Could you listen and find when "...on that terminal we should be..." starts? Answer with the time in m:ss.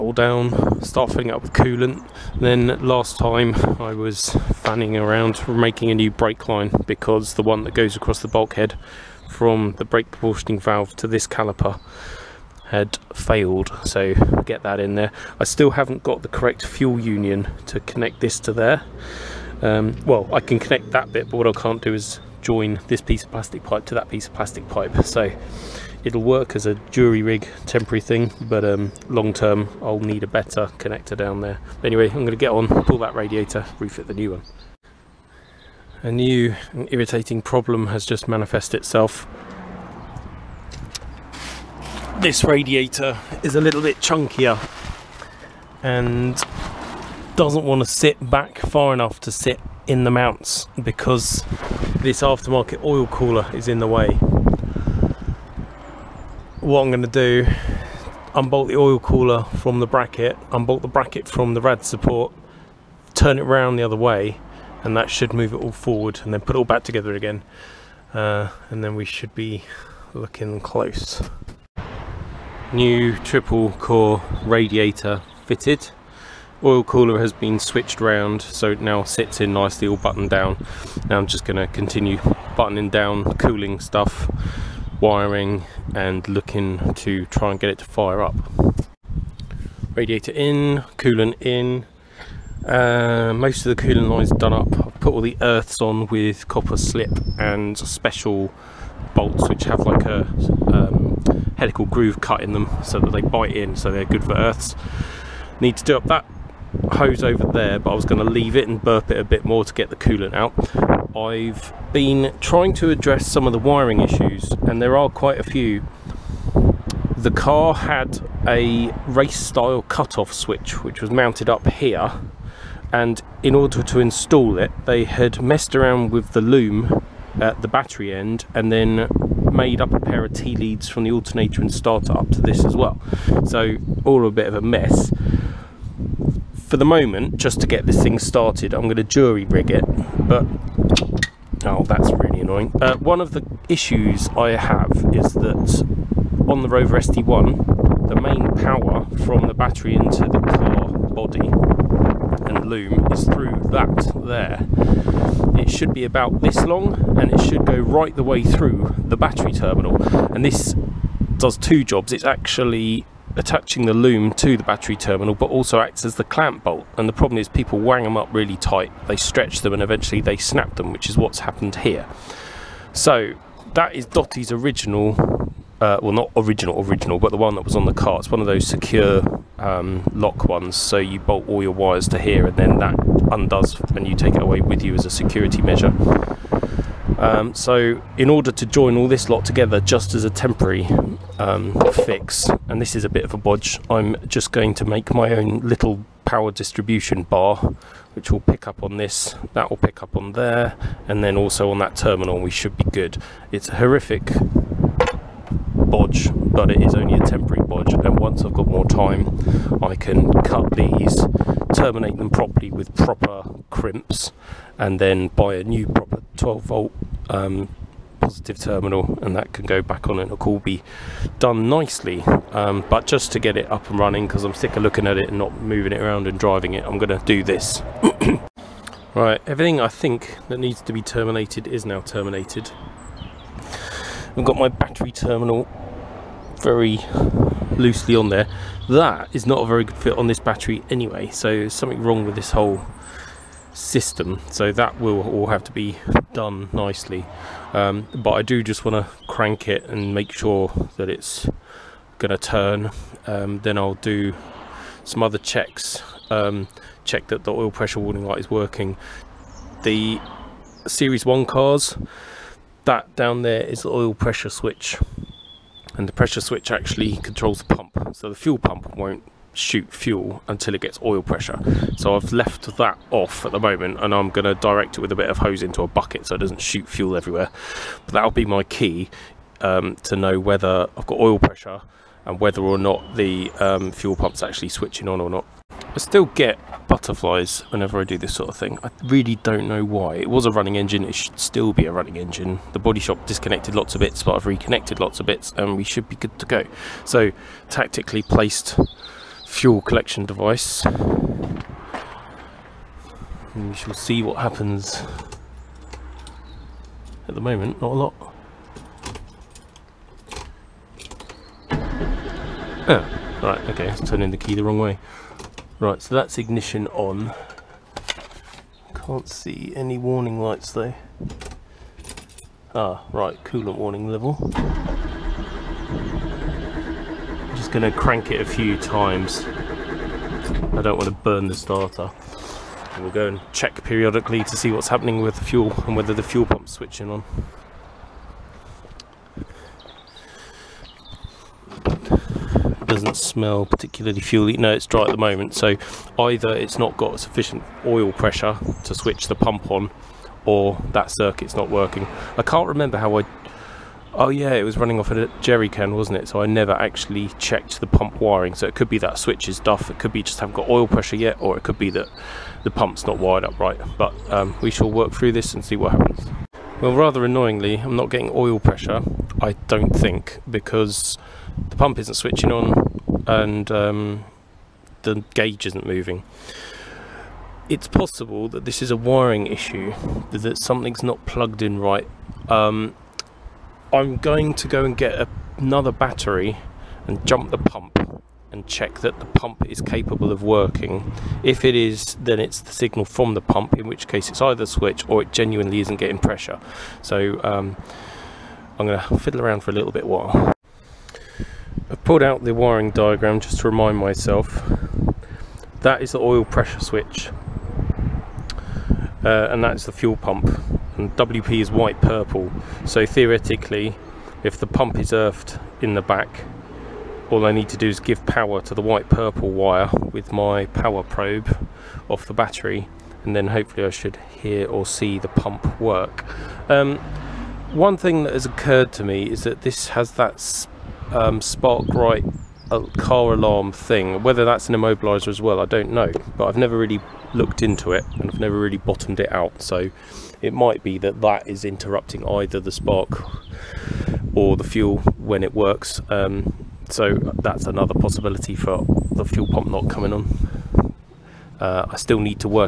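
3:21.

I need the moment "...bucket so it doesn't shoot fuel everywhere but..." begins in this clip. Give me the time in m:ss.
4:35.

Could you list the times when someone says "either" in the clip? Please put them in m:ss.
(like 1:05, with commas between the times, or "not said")
5:46, 6:34, 7:22.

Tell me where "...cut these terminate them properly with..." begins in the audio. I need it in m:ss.
3:30.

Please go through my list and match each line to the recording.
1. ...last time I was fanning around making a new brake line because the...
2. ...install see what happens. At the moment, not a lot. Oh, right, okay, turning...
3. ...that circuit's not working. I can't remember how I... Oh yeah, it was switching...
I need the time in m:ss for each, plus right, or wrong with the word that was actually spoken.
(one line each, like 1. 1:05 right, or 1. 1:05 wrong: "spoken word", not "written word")
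1. 0:02 right
2. 5:03 wrong: "shall", not "install"
3. 5:50 wrong: "running", not "switching".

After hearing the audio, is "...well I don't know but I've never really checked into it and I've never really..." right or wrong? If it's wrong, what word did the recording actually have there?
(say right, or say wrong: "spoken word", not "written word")
wrong: "looked", not "checked".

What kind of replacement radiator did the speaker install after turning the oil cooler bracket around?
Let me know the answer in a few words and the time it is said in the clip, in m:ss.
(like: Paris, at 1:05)
triple core, at 1:13.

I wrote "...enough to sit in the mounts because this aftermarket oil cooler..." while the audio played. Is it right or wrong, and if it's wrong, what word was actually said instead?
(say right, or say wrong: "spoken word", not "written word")
right.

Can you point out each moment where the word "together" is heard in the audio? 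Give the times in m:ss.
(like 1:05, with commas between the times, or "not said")
1:06, 3:09.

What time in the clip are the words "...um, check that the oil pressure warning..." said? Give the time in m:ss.
4:16.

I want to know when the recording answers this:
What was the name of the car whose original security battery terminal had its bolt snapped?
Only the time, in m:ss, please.
2:54.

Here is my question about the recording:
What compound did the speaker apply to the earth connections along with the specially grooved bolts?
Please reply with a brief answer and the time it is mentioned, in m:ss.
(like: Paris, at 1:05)
copper slip, at 1:36.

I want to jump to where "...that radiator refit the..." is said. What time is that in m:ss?
0:32.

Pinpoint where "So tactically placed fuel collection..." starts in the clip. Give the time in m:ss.
4:57.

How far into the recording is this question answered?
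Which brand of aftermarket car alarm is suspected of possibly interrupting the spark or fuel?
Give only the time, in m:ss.
7:11.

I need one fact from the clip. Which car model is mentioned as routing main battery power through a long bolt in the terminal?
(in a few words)
Rover SD1.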